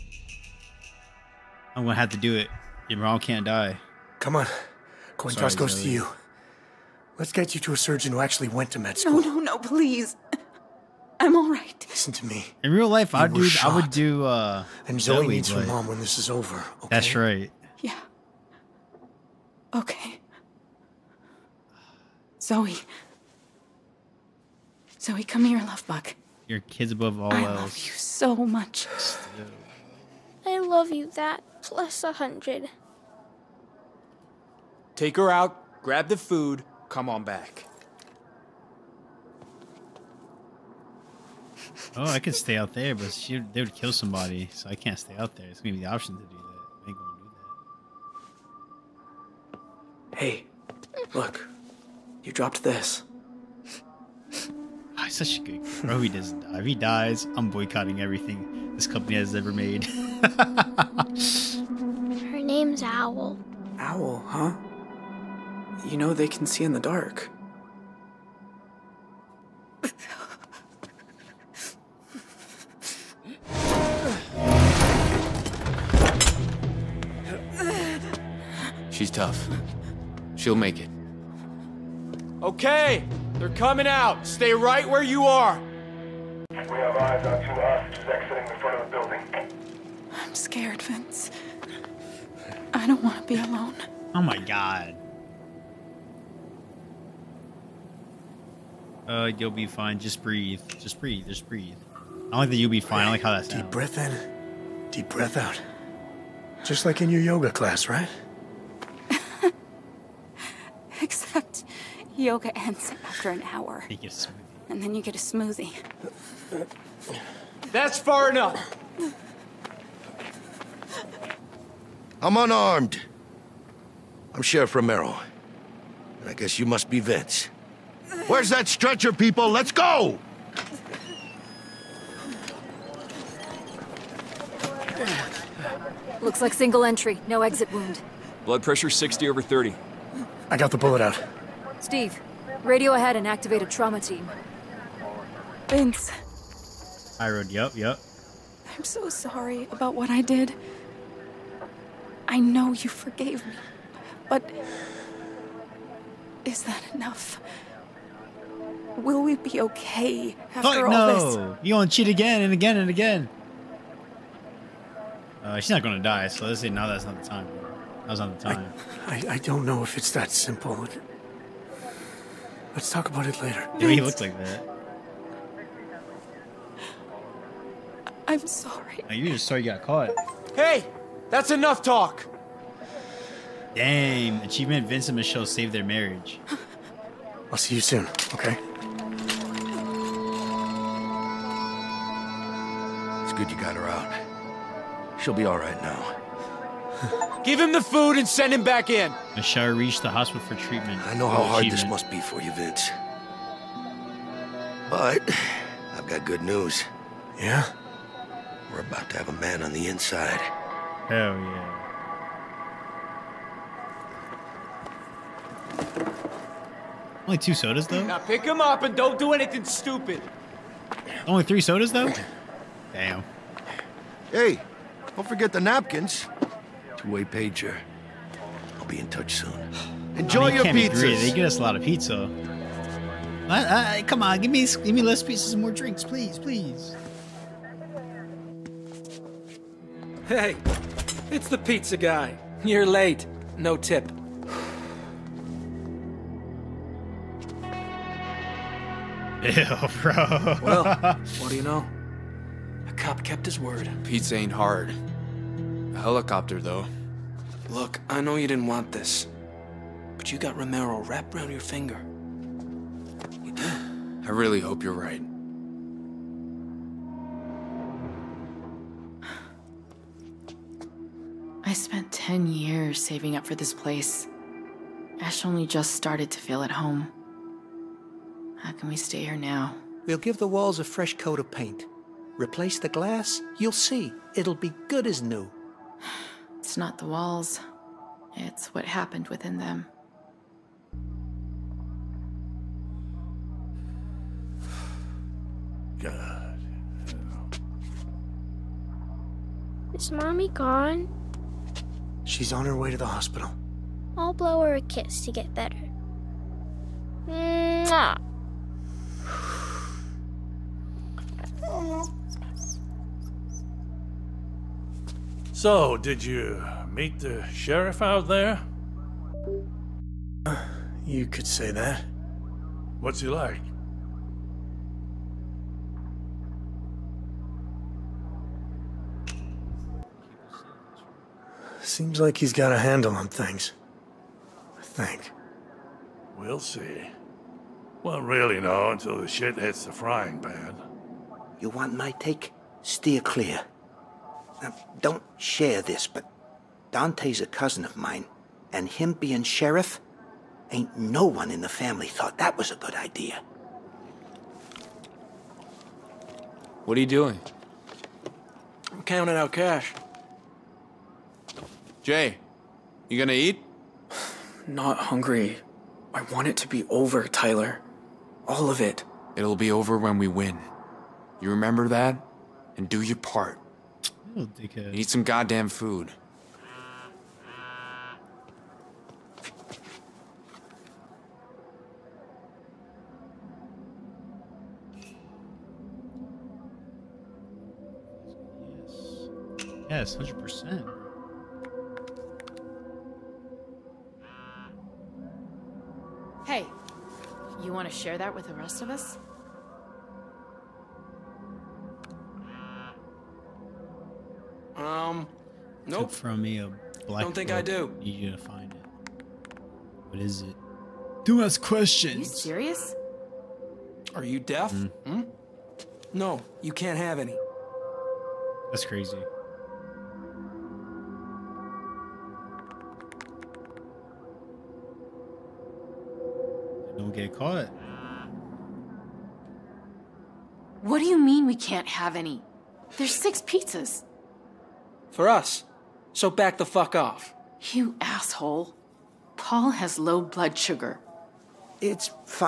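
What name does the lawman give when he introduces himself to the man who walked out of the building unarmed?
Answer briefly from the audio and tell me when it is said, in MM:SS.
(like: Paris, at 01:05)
Sheriff Romero, at 02:04.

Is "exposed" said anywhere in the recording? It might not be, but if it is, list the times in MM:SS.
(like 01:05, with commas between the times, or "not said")
not said.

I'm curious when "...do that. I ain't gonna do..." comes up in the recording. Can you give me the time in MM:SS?
00:46.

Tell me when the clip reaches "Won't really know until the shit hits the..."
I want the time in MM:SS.
05:38.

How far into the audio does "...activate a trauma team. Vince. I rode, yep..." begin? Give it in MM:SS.
02:23.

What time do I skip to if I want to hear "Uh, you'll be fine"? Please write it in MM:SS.
01:39.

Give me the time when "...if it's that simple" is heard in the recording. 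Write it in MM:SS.
02:49.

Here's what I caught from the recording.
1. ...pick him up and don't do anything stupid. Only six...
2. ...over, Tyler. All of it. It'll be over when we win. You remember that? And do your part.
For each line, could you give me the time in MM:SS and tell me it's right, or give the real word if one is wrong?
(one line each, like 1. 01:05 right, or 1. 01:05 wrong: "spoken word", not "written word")
1. 03:38 wrong: "three", not "six"
2. 06:06 right.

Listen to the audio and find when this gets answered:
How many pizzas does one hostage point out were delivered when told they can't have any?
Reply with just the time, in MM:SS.
07:13.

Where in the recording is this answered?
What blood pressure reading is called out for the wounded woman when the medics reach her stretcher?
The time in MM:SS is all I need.
02:18.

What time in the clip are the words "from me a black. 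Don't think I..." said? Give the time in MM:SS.
06:46.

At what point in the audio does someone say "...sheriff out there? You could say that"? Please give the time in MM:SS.
05:17.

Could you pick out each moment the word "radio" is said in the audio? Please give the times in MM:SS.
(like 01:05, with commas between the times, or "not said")
02:22.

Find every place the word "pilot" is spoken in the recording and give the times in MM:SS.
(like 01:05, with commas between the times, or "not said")
not said.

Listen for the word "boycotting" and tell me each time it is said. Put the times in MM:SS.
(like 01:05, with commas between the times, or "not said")
00:57.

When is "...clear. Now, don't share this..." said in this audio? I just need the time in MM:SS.
05:43.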